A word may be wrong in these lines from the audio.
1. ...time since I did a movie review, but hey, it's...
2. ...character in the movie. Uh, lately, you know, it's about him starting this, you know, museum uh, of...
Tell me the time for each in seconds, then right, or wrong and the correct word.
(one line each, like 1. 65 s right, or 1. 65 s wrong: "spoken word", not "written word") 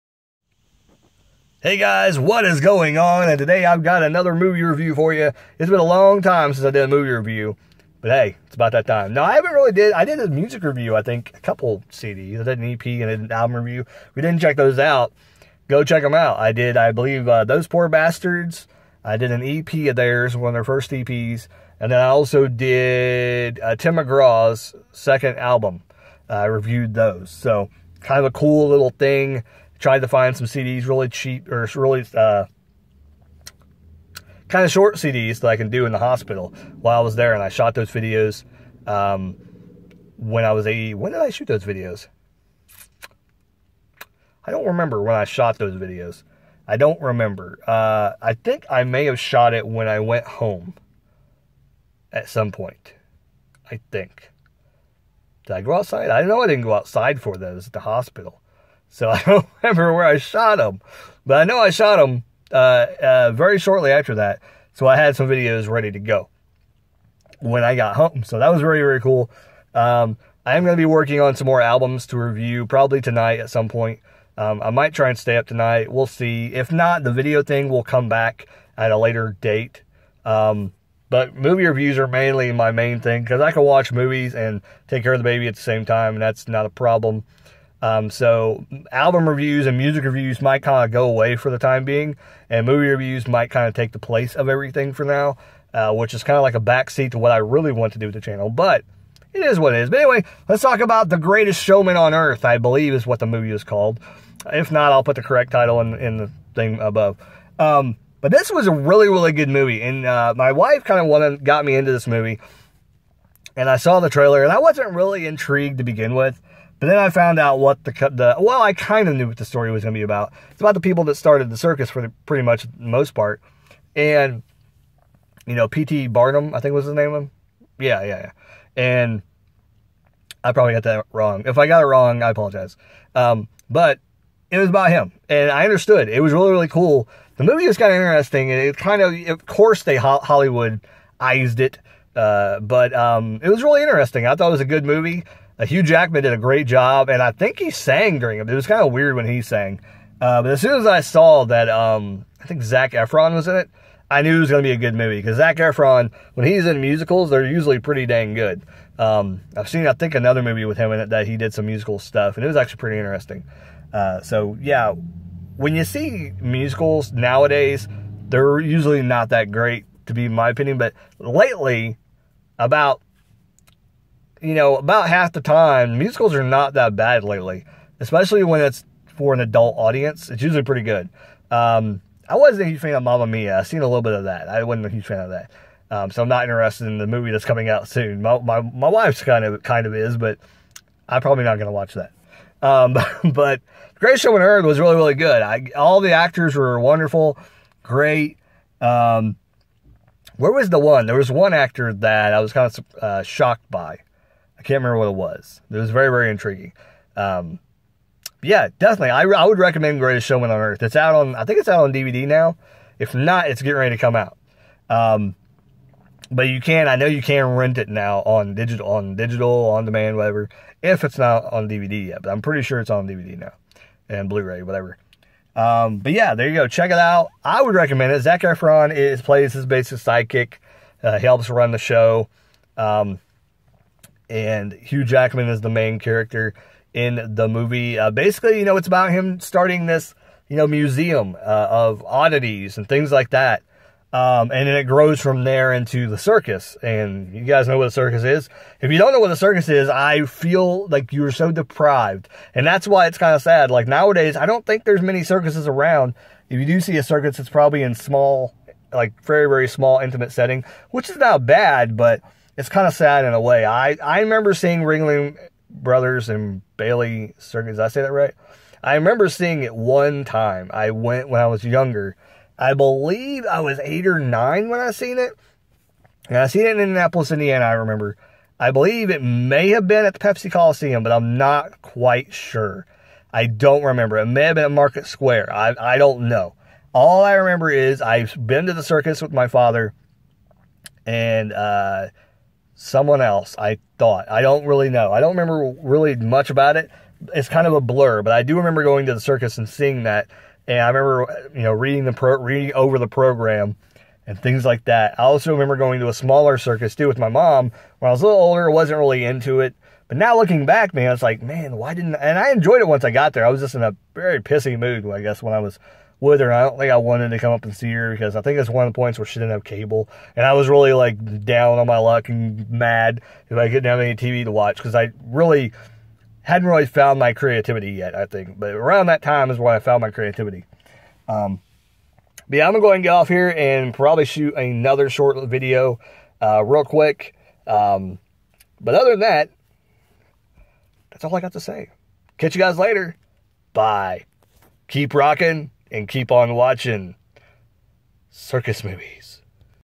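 1. 6 s right
2. 235 s wrong: "basically", not "lately".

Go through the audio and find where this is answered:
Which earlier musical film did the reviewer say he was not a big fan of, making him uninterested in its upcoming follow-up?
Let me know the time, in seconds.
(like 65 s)
183 s.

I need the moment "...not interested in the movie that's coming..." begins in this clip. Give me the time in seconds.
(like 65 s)
186 s.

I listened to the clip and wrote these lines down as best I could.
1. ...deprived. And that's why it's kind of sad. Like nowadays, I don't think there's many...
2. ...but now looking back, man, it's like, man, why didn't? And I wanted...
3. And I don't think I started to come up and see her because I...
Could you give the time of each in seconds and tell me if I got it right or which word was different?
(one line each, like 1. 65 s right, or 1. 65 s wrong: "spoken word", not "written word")
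1. 251 s right
2. 310 s wrong: "enjoyed", not "wanted"
3. 316 s wrong: "wanted", not "started".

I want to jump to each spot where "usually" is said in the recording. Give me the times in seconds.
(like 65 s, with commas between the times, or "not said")
157 s, 168 s, 180 s.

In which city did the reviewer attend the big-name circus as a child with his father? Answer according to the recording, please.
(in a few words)
Indianapolis.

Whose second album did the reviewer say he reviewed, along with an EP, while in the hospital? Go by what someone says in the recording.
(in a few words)
Tim McGraw.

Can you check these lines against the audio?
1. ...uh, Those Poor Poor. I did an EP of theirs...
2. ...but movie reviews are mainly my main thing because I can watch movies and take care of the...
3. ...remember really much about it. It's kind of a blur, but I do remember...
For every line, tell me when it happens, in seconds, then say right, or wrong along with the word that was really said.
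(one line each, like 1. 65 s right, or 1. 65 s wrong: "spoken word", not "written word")
1. 17 s wrong: "Bastards", not "Poor"
2. 81 s right
3. 295 s right.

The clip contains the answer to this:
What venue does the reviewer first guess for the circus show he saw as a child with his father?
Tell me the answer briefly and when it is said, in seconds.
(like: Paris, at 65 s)
Pepsi Coliseum, at 280 s.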